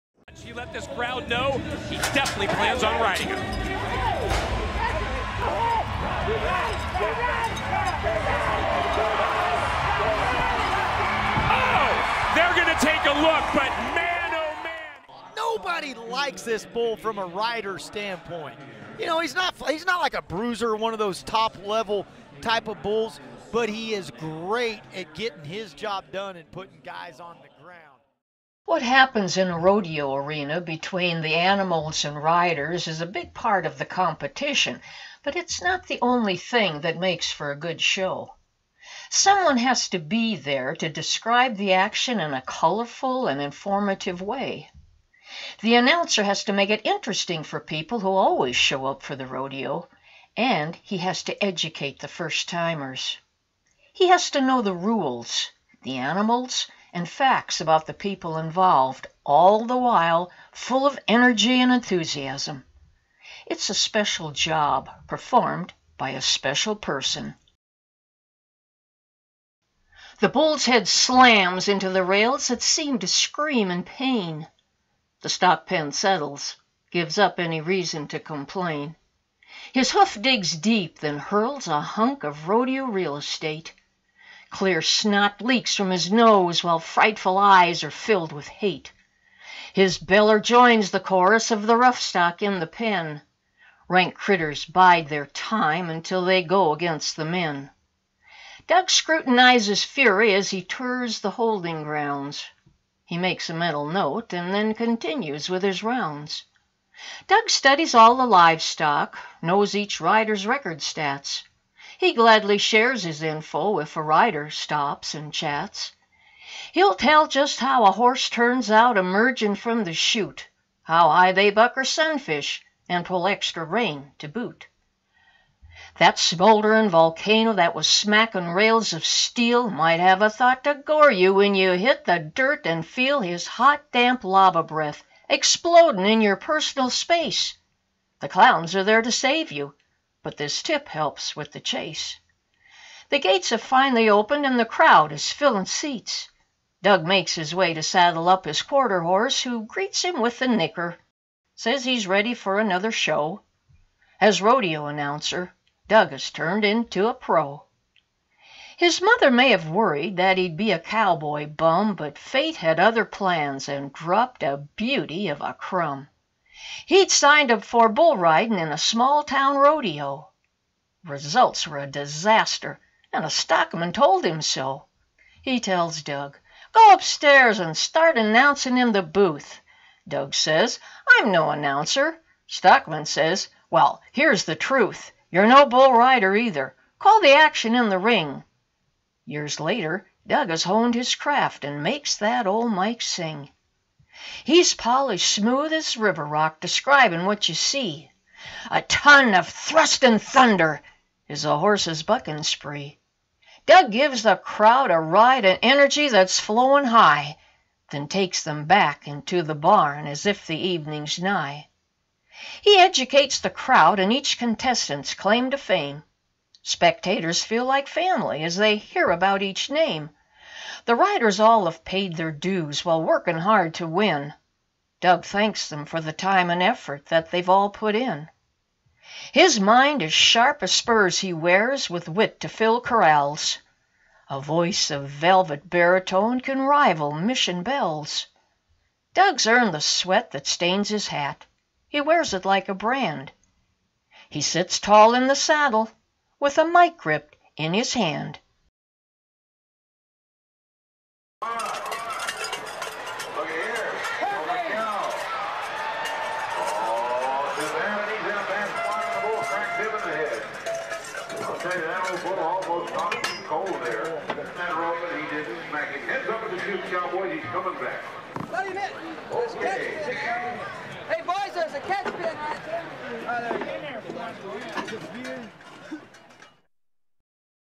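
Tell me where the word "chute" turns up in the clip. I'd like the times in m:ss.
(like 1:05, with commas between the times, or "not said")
1:59, 4:26.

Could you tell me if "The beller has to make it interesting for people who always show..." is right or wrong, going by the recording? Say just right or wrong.
wrong.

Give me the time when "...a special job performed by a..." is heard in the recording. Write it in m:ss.
1:03.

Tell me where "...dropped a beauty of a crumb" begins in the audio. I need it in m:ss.
2:43.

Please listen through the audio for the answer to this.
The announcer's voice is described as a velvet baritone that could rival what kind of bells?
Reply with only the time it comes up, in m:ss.
3:57.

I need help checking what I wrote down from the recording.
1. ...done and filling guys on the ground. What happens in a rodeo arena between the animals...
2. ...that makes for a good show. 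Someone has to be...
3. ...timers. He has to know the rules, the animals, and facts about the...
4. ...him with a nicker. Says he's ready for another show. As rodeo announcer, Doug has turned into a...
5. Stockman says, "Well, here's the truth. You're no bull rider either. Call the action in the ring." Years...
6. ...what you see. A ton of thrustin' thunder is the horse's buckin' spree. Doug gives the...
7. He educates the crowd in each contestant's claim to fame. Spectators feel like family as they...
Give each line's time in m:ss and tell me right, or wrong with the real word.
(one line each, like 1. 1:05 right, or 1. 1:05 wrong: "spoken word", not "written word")
1. 0:26 wrong: "putting", not "filling"
2. 0:36 right
3. 0:52 right
4. 2:30 right
5. 3:02 right
6. 3:17 right
7. 3:32 right.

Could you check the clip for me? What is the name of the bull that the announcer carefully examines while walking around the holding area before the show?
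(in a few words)
Fury.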